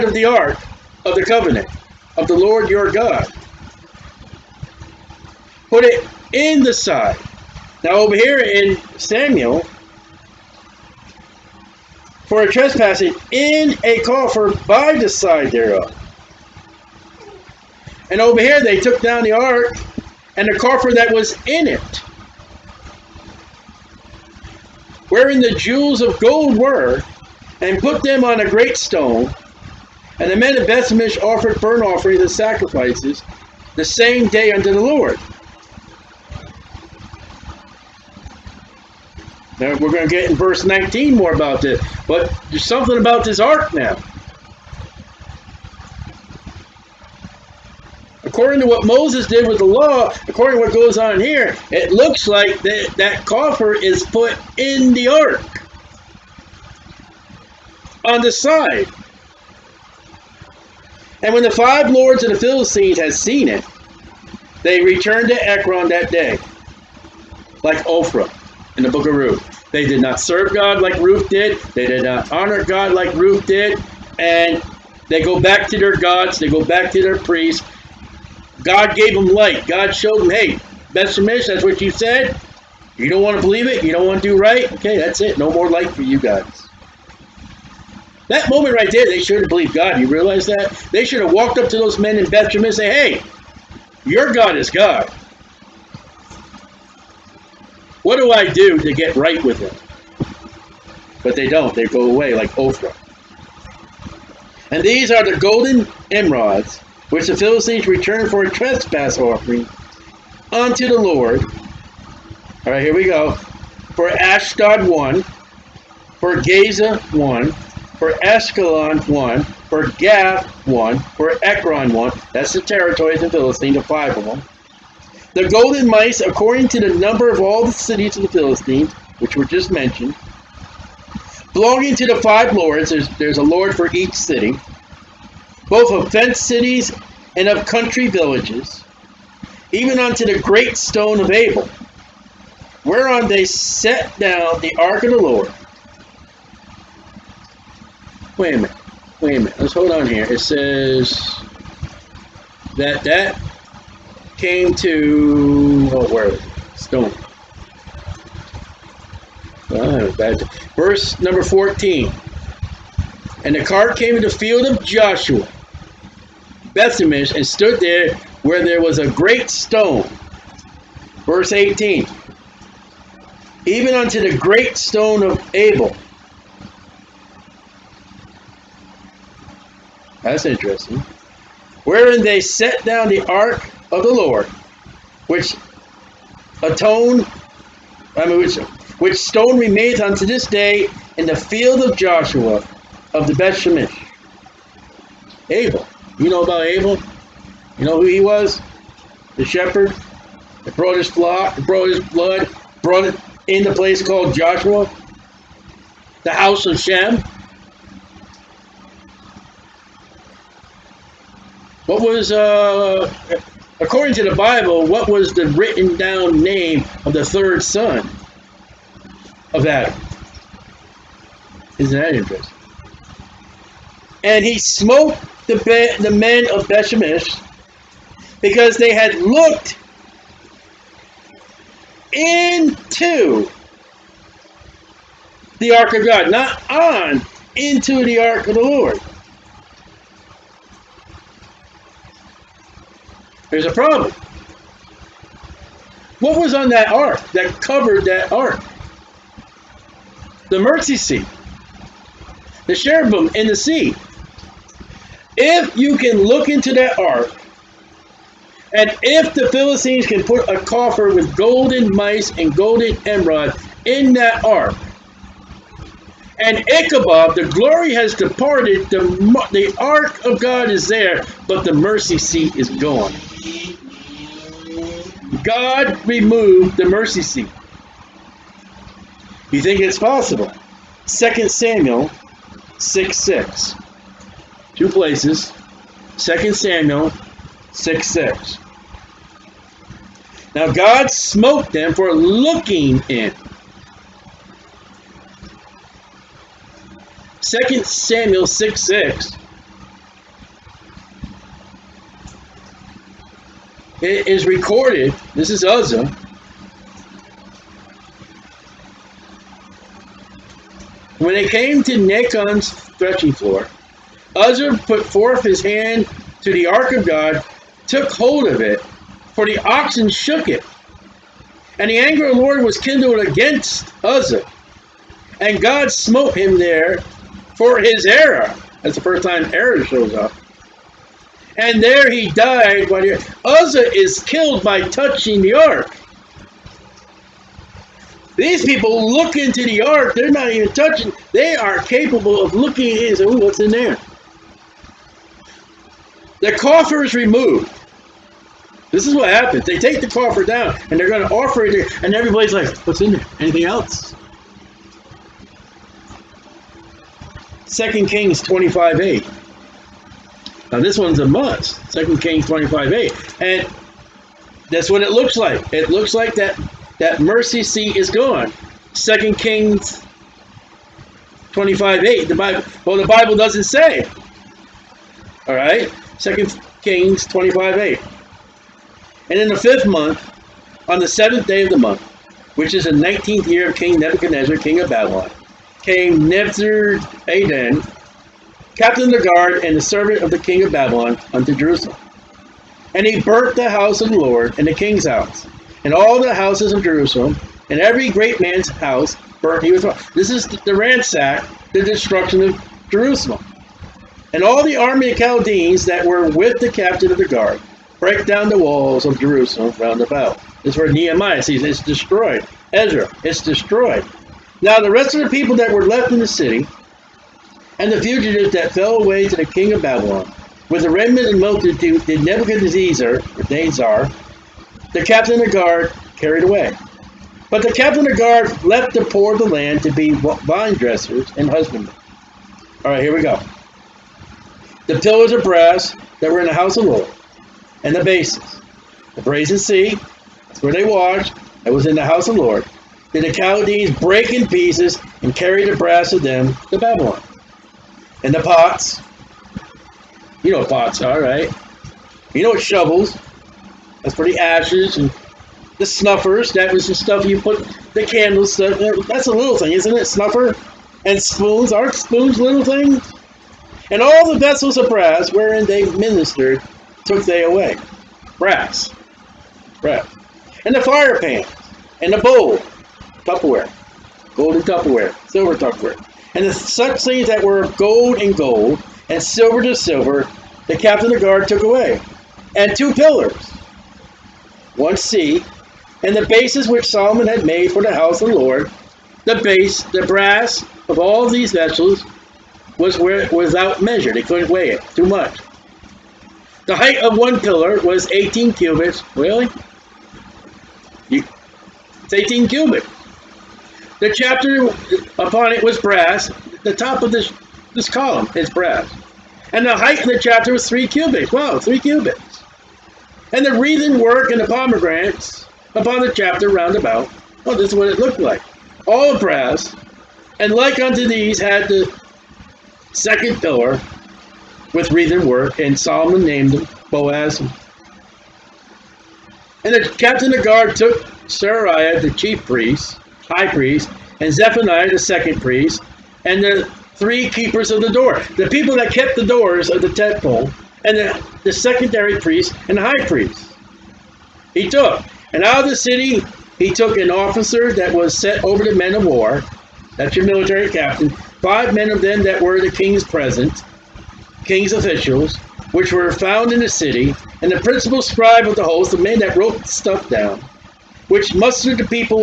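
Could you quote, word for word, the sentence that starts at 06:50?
This is where Nehemiah sees it's destroyed.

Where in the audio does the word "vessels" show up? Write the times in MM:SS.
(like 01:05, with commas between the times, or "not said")
07:44, 08:11.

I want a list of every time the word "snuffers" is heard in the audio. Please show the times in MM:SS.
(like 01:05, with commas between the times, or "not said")
07:35, 07:40.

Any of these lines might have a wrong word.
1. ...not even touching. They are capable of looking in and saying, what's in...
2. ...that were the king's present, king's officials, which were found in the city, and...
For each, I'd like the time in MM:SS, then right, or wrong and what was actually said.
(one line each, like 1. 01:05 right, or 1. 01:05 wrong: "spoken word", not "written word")
1. 05:40 right
2. 09:12 right.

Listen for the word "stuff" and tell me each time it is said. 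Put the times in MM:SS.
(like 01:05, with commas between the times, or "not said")
07:36, 09:19.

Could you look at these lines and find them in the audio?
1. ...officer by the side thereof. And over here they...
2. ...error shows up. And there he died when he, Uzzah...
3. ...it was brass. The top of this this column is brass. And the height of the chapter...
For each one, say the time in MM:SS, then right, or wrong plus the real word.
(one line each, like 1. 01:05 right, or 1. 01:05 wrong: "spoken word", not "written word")
1. 00:14 wrong: "coffer", not "officer"
2. 05:29 right
3. 08:25 right.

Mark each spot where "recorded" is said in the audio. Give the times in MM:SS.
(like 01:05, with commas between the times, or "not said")
05:04.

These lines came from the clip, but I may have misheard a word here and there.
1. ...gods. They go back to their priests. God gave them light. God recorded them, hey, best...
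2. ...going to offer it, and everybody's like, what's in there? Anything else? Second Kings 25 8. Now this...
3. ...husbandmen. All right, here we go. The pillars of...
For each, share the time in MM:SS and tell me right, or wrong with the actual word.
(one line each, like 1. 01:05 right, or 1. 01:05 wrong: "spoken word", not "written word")
1. 01:15 wrong: "showed", not "recorded"
2. 05:51 right
3. 07:11 right.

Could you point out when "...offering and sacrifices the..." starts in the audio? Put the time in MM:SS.
00:31.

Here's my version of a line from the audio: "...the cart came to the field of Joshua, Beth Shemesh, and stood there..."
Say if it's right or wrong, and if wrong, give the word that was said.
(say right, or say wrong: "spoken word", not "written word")
right.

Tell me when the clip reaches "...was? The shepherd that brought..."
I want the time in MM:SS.
03:18.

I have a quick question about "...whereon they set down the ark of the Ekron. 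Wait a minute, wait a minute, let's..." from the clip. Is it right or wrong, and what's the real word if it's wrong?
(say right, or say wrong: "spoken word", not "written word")
wrong: "Lord", not "Ekron".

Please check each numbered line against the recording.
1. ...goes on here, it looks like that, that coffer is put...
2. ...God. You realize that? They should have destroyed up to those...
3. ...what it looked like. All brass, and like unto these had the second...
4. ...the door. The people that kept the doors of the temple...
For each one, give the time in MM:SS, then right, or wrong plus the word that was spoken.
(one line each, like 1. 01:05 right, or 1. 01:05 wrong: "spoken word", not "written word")
1. 00:50 right
2. 01:29 wrong: "walked", not "destroyed"
3. 08:37 right
4. 08:57 right.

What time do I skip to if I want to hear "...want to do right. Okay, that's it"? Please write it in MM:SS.
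01:24.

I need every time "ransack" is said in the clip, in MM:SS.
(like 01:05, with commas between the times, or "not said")
06:40.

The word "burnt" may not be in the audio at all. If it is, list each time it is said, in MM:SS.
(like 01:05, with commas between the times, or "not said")
00:31, 06:33, 06:39.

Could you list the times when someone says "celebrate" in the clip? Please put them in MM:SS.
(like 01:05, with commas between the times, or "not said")
not said.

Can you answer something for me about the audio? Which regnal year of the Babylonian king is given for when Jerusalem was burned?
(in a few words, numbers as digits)
19th.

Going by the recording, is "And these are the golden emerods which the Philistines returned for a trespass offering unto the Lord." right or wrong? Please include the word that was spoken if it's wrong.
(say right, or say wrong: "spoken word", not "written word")
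right.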